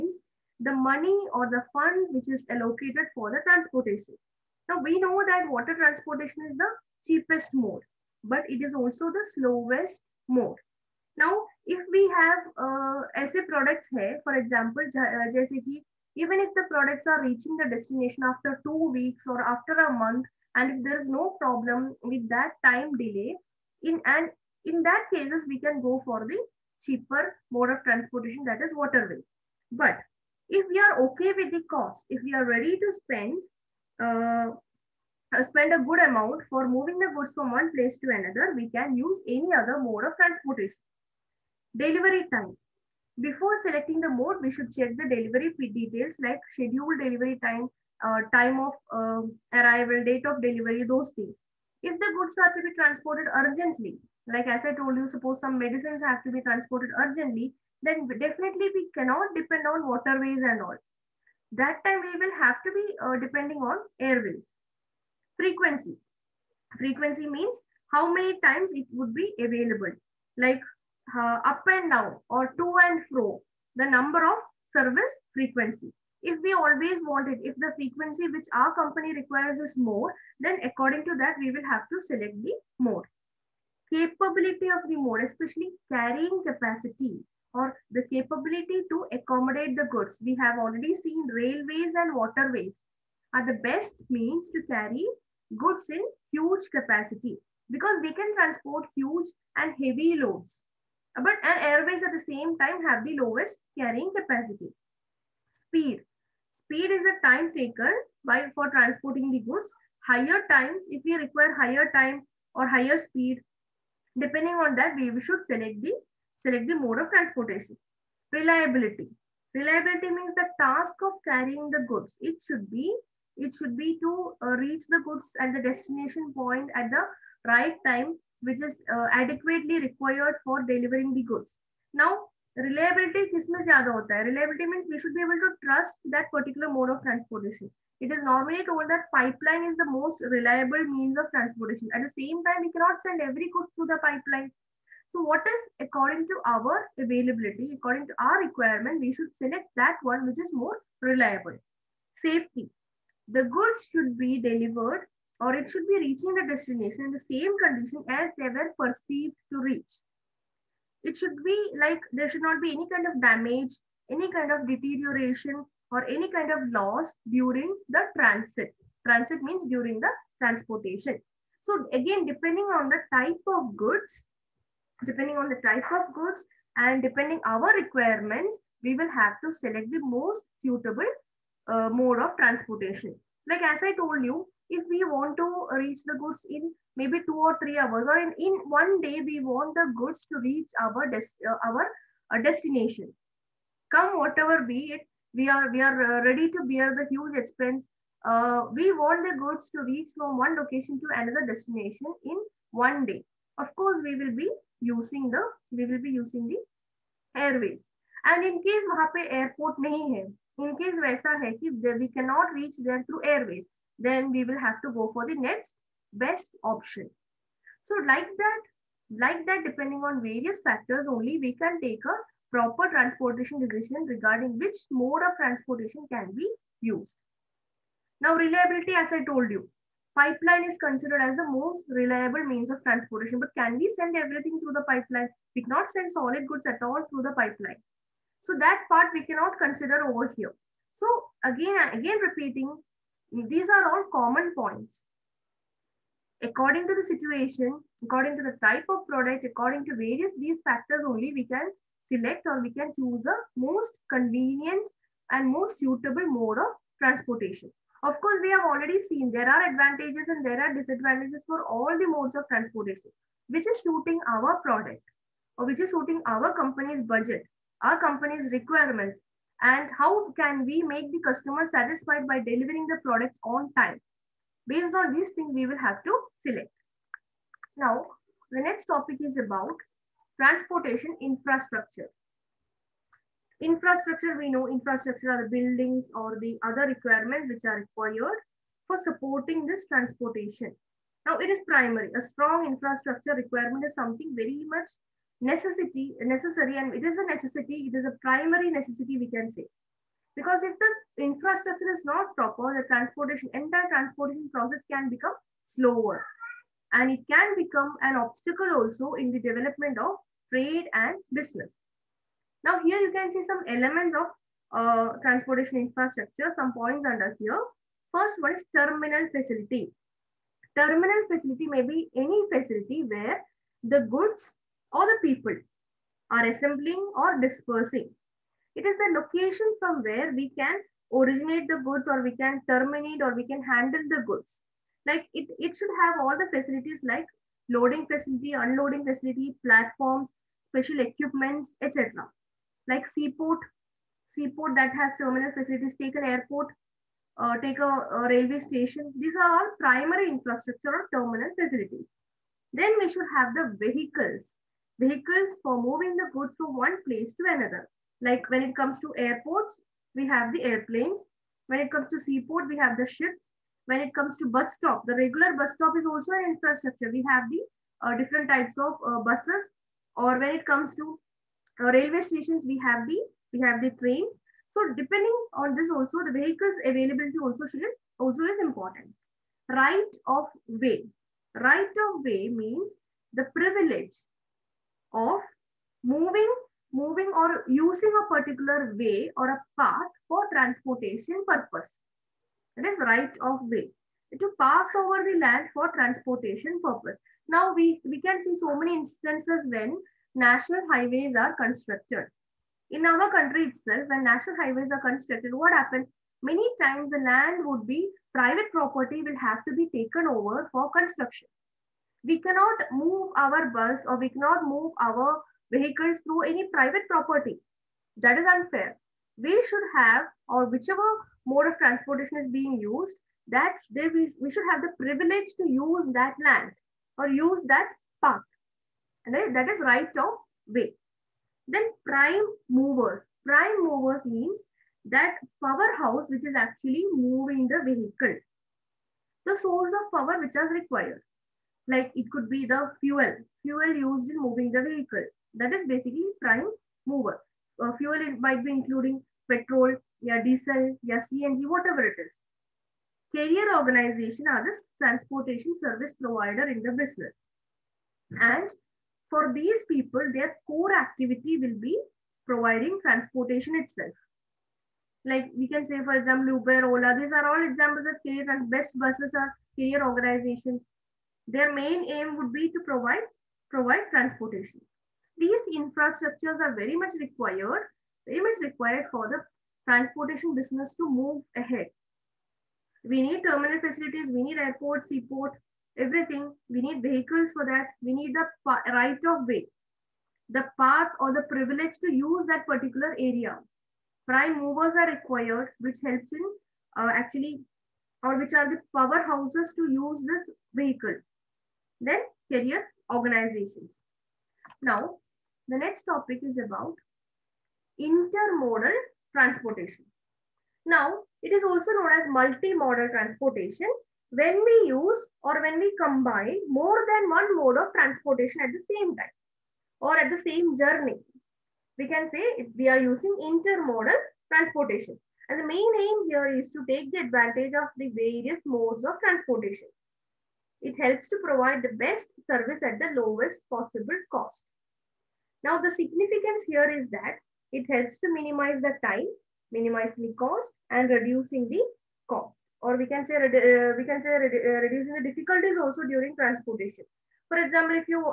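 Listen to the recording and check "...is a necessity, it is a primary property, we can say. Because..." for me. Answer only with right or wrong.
wrong.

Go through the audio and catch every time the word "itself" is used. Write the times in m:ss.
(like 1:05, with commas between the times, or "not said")
6:43, 7:43.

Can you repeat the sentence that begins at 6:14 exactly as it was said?
So depending on this also, the vehicles availability also is also is important.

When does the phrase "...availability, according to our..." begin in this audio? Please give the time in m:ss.
2:27.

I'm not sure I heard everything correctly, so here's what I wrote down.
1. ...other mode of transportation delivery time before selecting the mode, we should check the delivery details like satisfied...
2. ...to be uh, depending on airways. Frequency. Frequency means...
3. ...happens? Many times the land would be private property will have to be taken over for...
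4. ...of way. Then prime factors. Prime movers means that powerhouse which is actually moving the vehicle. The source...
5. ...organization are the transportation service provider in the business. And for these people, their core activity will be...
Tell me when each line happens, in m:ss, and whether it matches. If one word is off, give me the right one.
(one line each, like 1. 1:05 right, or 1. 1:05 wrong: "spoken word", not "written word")
1. 0:39 wrong: "scheduled", not "satisfied"
2. 1:02 right
3. 6:45 right
4. 7:10 wrong: "movers", not "factors"
5. 7:33 right.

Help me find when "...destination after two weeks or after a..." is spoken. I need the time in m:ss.
0:17.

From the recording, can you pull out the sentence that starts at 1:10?
Like uh, up and down or to and fro the number of service frequency.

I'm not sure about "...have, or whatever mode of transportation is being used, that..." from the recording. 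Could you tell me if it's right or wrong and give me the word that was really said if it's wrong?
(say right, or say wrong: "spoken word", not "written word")
wrong: "whichever", not "whatever".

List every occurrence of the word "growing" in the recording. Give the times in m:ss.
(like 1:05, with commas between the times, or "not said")
not said.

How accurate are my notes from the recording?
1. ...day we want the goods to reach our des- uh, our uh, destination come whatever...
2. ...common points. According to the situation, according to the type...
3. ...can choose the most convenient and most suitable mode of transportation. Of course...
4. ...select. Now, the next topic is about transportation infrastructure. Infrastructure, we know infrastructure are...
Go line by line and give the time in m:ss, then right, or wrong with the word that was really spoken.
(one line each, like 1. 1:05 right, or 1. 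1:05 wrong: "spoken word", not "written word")
1. 3:09 right
2. 4:04 right
3. 4:12 right
4. 4:36 right.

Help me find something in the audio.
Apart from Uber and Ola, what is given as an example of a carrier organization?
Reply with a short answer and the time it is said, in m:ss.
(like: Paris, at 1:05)
BEST buses, at 7:48.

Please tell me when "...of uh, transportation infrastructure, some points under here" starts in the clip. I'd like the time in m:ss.
5:14.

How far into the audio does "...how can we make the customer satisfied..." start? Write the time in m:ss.
4:29.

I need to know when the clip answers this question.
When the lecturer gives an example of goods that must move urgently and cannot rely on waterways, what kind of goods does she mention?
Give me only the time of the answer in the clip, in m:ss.
0:55.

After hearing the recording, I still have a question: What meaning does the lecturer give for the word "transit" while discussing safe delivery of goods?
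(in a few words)
During the transportation.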